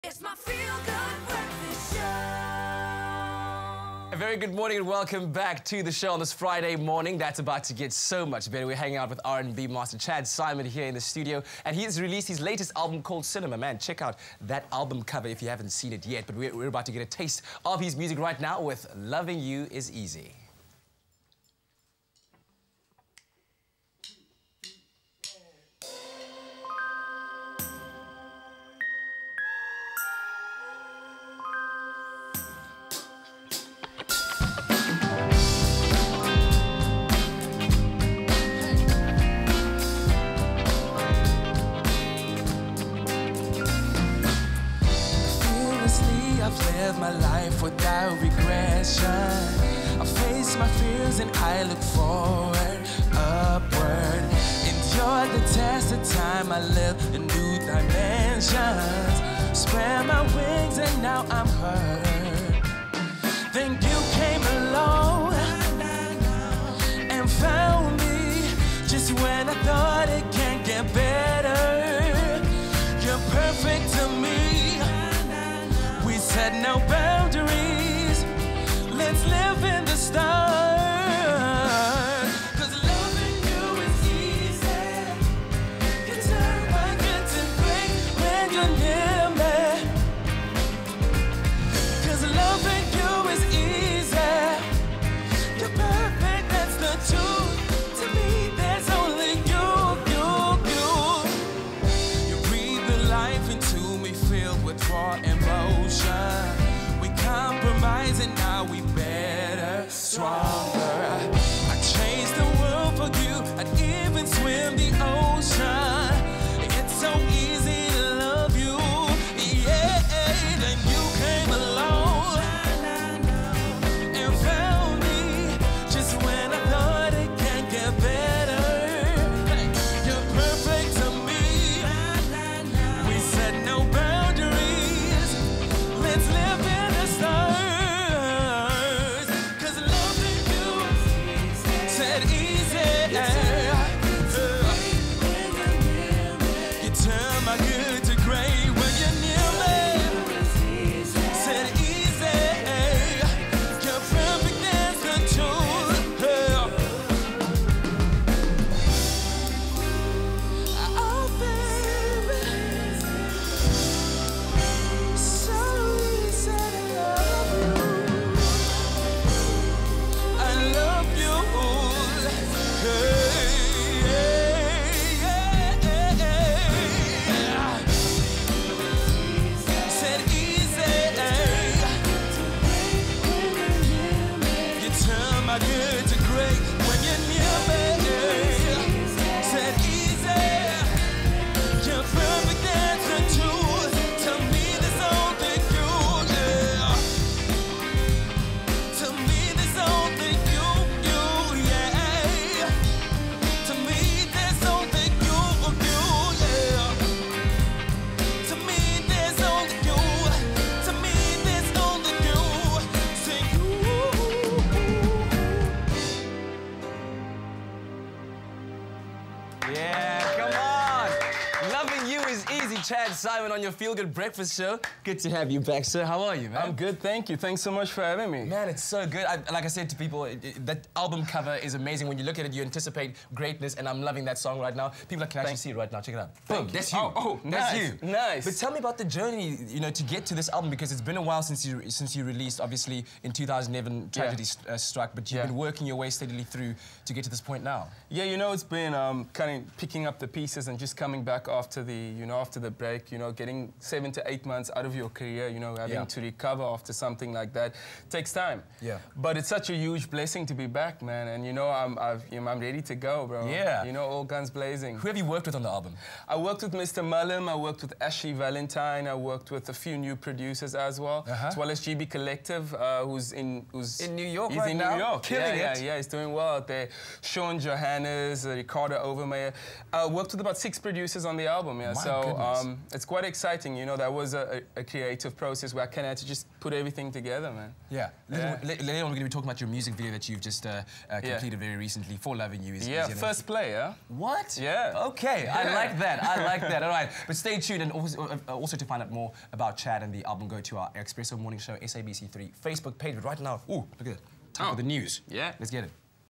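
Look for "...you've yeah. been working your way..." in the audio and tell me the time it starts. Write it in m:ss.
4:05.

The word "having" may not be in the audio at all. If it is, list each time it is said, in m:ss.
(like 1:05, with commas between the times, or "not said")
3:48, 4:15.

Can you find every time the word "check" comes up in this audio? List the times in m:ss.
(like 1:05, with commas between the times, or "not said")
0:13, 3:56.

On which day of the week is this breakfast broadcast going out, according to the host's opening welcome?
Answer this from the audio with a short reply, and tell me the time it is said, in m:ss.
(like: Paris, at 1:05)
Friday, at 0:06.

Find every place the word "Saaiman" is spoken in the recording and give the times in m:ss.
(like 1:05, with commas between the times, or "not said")
0:10, 3:43.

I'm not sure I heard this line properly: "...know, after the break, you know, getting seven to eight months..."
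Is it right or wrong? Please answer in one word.
right.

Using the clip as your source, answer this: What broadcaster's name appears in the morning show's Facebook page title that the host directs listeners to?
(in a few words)
SABC3.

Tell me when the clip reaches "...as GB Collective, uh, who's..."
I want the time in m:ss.
4:31.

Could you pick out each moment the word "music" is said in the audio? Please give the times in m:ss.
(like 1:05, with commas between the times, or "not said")
0:17, 4:49.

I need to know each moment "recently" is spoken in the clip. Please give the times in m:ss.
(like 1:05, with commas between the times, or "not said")
4:51.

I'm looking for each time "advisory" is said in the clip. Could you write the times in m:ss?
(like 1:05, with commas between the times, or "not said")
not said.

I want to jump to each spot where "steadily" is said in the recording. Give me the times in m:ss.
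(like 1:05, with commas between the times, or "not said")
4:06.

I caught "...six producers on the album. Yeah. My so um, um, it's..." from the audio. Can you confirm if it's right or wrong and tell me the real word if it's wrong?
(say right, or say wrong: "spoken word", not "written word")
right.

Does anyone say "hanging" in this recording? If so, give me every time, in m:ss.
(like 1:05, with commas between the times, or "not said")
0:08.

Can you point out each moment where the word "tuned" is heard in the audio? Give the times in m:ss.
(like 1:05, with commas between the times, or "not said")
4:57.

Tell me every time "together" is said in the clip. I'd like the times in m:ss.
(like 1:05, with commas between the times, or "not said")
4:47.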